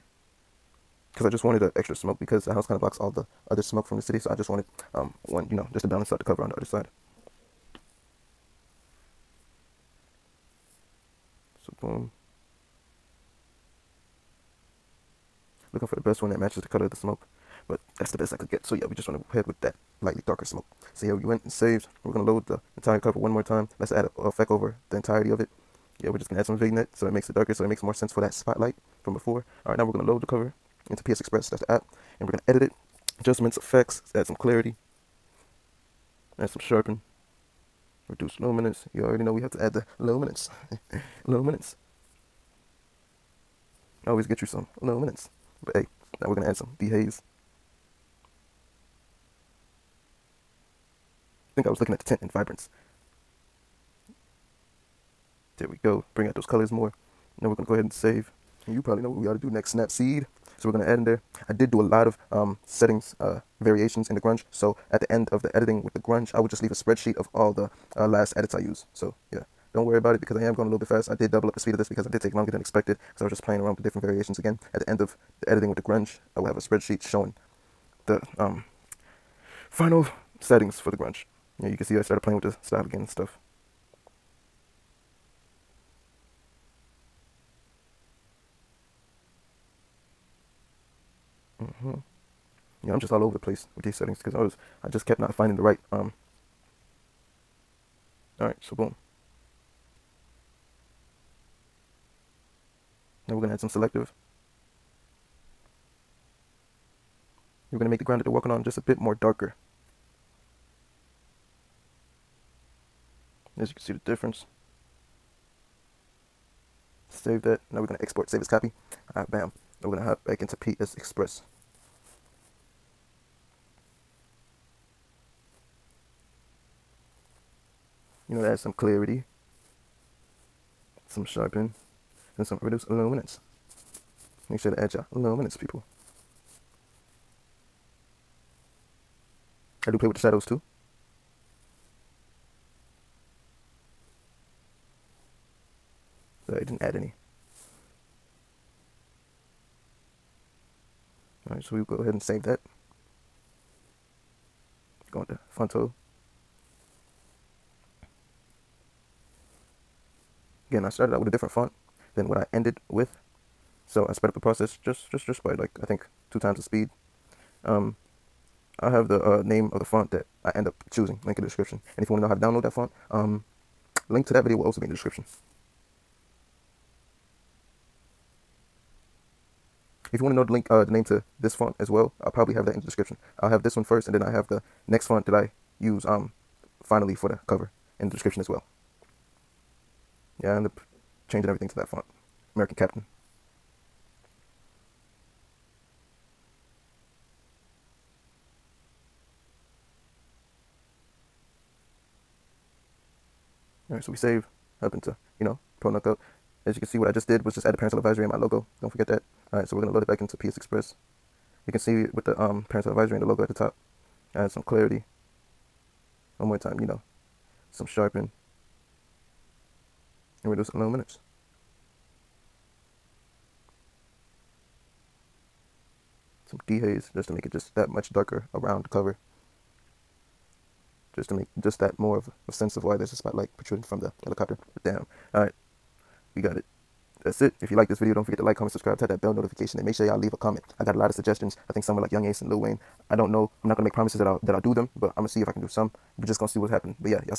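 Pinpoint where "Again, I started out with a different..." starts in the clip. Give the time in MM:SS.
02:40.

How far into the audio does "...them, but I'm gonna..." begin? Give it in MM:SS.
04:04.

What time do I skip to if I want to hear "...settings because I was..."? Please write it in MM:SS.
01:33.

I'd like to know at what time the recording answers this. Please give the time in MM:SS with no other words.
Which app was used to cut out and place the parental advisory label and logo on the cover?
03:25.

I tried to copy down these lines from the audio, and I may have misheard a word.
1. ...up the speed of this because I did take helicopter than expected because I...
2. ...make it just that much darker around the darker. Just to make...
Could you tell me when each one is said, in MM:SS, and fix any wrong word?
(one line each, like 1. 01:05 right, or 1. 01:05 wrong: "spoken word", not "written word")
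1. 01:11 wrong: "longer", not "helicopter"
2. 03:47 wrong: "cover", not "darker".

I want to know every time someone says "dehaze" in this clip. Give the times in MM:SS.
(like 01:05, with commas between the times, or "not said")
00:46, 03:46.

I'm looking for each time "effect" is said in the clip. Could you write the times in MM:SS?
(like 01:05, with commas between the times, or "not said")
00:24, 00:33.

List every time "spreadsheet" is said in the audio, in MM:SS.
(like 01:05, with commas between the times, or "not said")
01:06, 01:16.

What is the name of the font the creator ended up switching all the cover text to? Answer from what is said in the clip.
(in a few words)
American Captain.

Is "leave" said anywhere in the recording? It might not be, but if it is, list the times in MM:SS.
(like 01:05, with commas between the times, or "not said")
01:06, 04:00.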